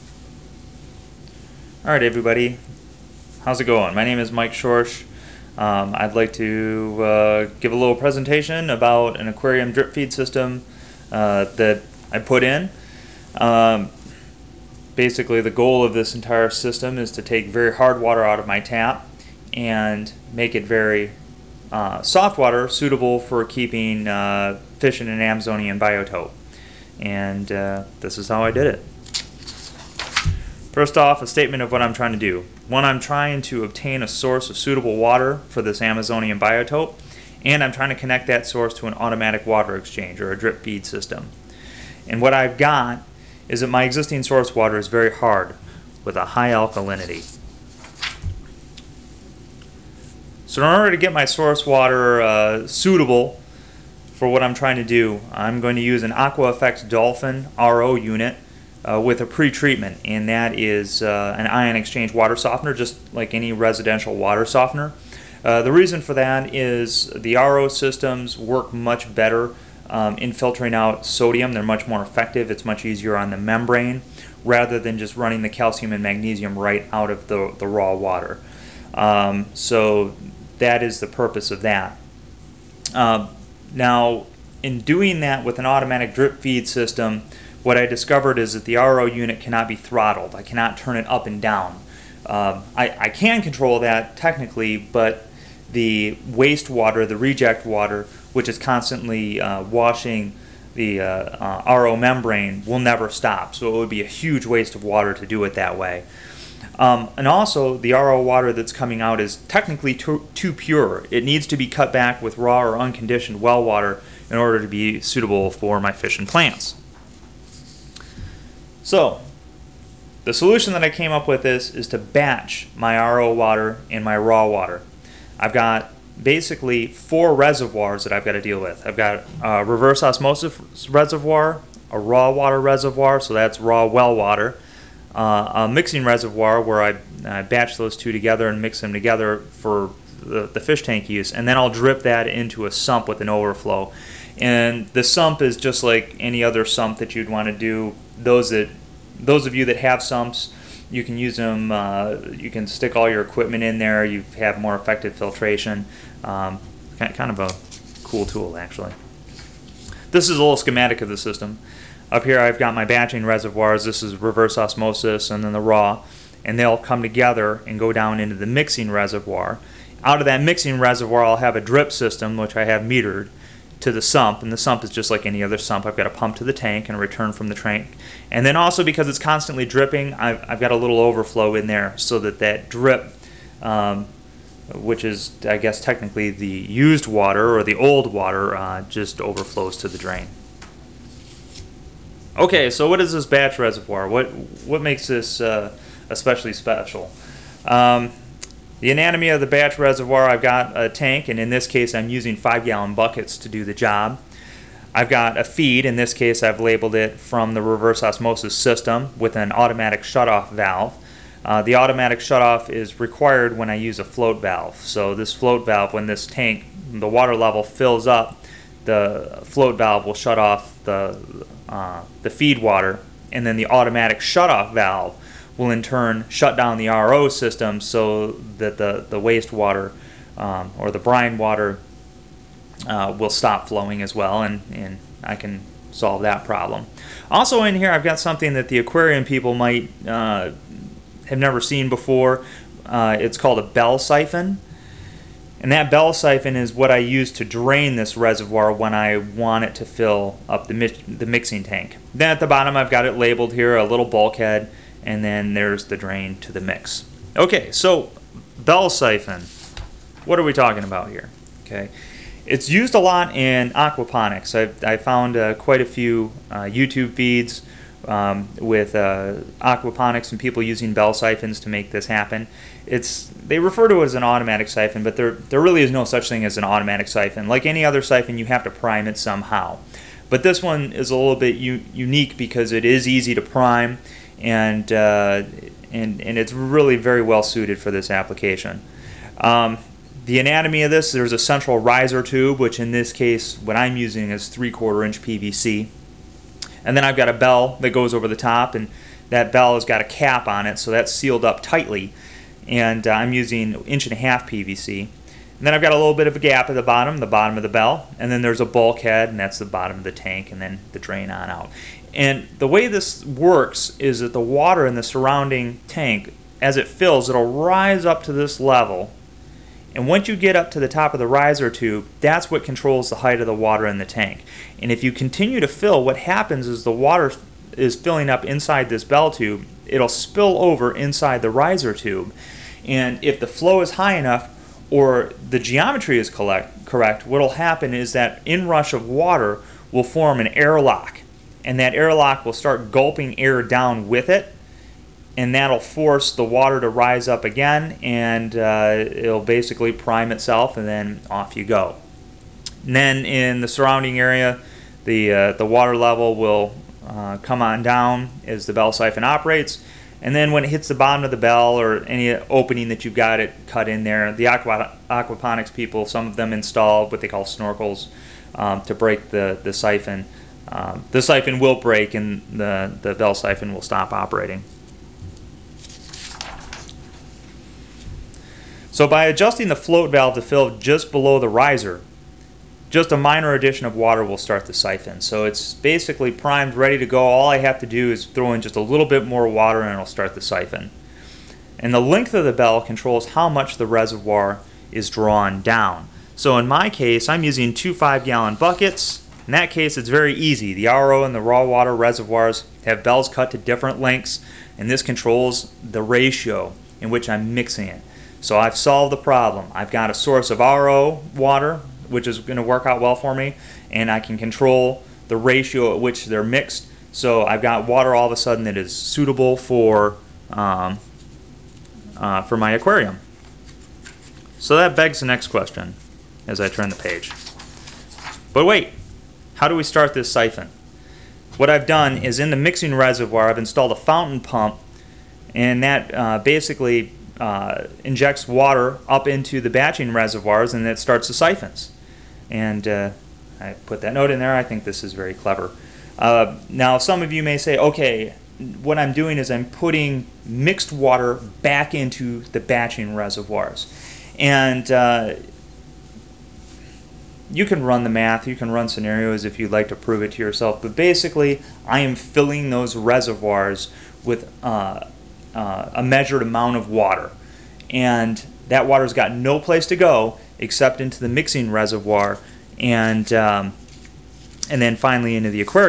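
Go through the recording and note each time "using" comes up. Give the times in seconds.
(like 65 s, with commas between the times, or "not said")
202 s, 270 s, 293 s, 303 s, 397 s.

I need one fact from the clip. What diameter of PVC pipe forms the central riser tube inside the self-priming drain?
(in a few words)
3/4 inch.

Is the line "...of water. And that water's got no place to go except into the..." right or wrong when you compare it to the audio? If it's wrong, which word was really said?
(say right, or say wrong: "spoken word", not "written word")
right.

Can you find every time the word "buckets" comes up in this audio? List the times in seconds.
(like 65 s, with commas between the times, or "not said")
202 s, 398 s.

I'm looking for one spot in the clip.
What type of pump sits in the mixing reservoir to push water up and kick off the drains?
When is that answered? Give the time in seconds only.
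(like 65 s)
433 s.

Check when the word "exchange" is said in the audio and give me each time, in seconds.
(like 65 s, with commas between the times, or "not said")
39 s, 61 s.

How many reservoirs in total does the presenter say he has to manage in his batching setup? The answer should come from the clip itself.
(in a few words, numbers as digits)
4.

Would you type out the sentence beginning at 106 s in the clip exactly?
Um, and also, the RO water that's coming out is technically too, too, pure.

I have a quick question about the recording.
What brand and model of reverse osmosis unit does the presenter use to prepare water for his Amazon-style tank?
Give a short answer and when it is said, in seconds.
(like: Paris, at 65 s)
AquaFX Dolphin, at 56 s.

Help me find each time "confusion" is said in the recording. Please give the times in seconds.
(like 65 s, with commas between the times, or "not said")
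not said.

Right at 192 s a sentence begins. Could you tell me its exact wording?
Okay, so what is this batch reservoir?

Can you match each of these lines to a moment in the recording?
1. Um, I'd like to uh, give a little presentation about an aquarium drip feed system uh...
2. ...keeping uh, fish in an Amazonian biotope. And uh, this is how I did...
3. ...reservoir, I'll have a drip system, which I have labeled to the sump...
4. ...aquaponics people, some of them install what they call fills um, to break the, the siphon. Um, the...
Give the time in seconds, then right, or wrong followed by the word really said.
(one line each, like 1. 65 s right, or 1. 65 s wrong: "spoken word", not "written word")
1. 5 s right
2. 23 s right
3. 170 s wrong: "metered", not "labeled"
4. 365 s wrong: "snorkels", not "fills".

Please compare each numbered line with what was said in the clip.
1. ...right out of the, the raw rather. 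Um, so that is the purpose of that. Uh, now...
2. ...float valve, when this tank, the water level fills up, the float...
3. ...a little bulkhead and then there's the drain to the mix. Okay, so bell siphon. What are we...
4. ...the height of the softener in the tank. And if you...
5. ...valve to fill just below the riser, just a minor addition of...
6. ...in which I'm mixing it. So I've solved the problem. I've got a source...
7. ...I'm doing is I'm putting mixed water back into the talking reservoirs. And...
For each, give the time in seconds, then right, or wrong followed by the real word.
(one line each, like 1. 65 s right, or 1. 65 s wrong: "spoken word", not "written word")
1. 76 s wrong: "water", not "rather"
2. 215 s right
3. 253 s right
4. 323 s wrong: "water", not "softener"
5. 380 s right
6. 407 s right
7. 448 s wrong: "batching", not "talking".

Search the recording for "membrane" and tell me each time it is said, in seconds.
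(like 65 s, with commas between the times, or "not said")
73 s, 101 s.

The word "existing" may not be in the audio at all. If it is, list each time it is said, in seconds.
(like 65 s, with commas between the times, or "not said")
43 s.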